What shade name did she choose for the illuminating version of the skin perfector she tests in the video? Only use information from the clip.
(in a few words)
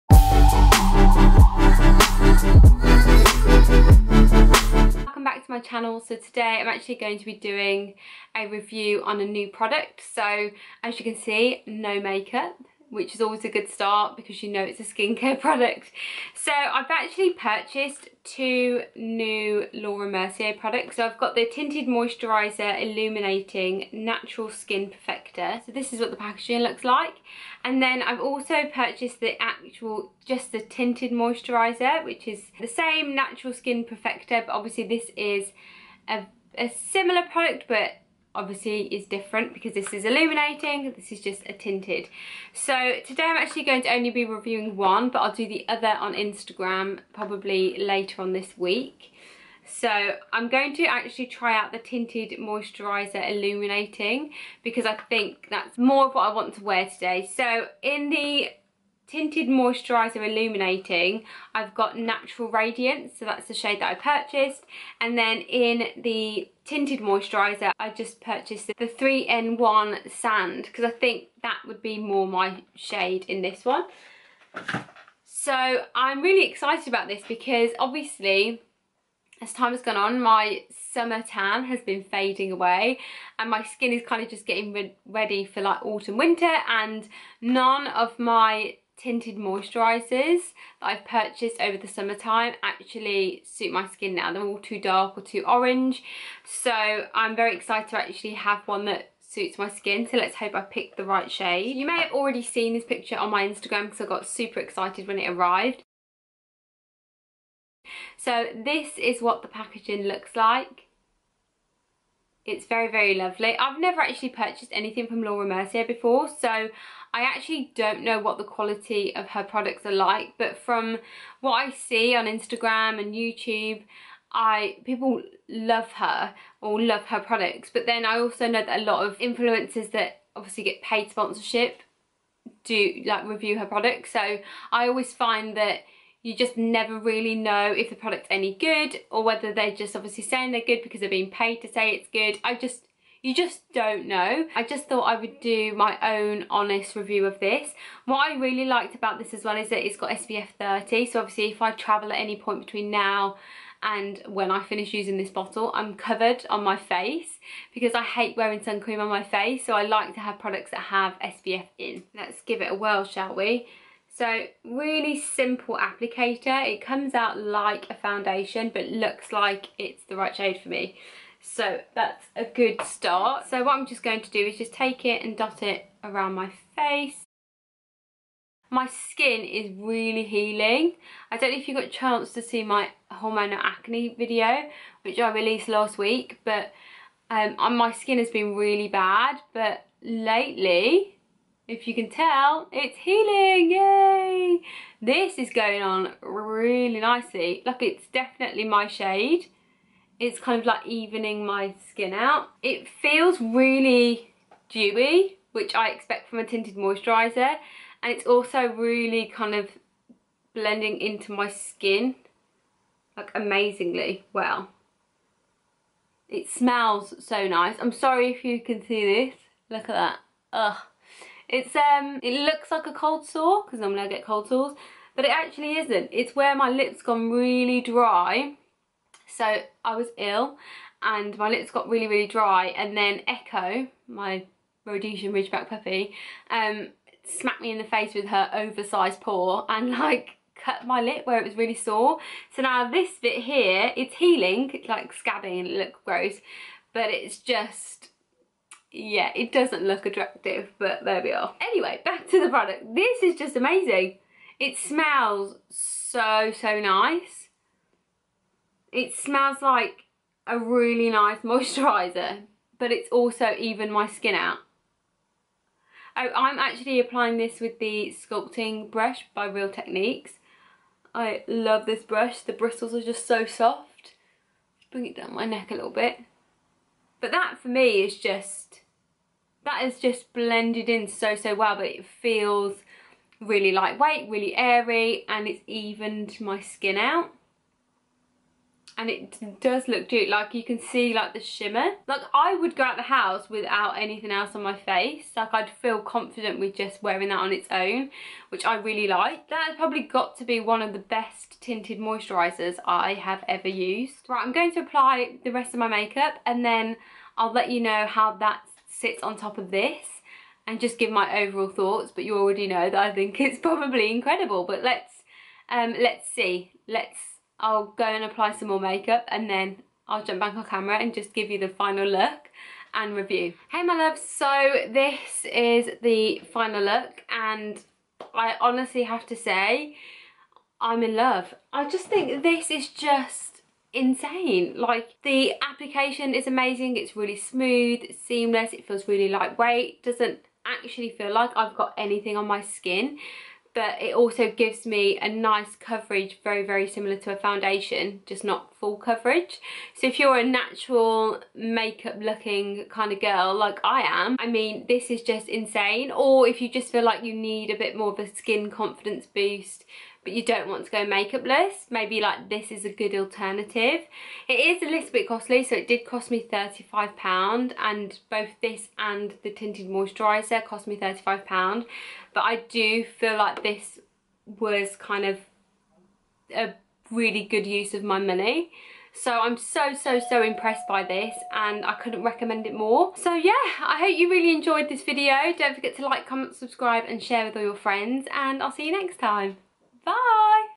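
Natural Radiance.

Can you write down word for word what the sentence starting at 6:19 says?
So I'm so, so, so impressed by this and I couldn't recommend it more.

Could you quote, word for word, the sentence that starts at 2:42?
Let's give it a whirl shall we?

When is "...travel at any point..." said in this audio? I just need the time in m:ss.
2:31.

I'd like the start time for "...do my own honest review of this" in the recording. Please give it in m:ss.
2:25.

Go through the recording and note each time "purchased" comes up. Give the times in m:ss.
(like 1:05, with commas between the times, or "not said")
0:17, 0:28, 1:03, 1:08, 1:31, 1:54.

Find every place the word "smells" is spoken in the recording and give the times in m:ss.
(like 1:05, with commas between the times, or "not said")
3:36, 4:14, 4:19.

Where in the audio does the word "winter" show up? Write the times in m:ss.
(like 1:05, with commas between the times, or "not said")
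1:26.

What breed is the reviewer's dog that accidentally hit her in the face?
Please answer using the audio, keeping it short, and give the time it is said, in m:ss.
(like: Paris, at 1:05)
Rhodesian Ridgeback, at 3:54.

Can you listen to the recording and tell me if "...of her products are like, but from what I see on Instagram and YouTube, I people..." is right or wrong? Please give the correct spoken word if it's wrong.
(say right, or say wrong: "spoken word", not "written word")
right.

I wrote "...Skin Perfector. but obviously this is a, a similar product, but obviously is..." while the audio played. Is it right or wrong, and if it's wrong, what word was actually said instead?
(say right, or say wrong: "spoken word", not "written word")
right.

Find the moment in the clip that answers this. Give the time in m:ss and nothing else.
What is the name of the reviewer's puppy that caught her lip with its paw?
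3:53.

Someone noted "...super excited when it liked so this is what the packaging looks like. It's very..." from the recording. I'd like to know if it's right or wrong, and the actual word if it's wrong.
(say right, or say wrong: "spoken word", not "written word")
wrong: "arrived", not "liked".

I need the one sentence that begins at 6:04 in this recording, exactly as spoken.
It is a little bit costly, so it did cost me £35 and both this and the tinted moisturiser cost me £35.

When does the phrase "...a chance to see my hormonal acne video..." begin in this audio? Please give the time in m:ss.
3:01.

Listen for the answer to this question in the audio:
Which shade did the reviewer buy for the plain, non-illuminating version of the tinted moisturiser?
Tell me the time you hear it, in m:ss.
1:08.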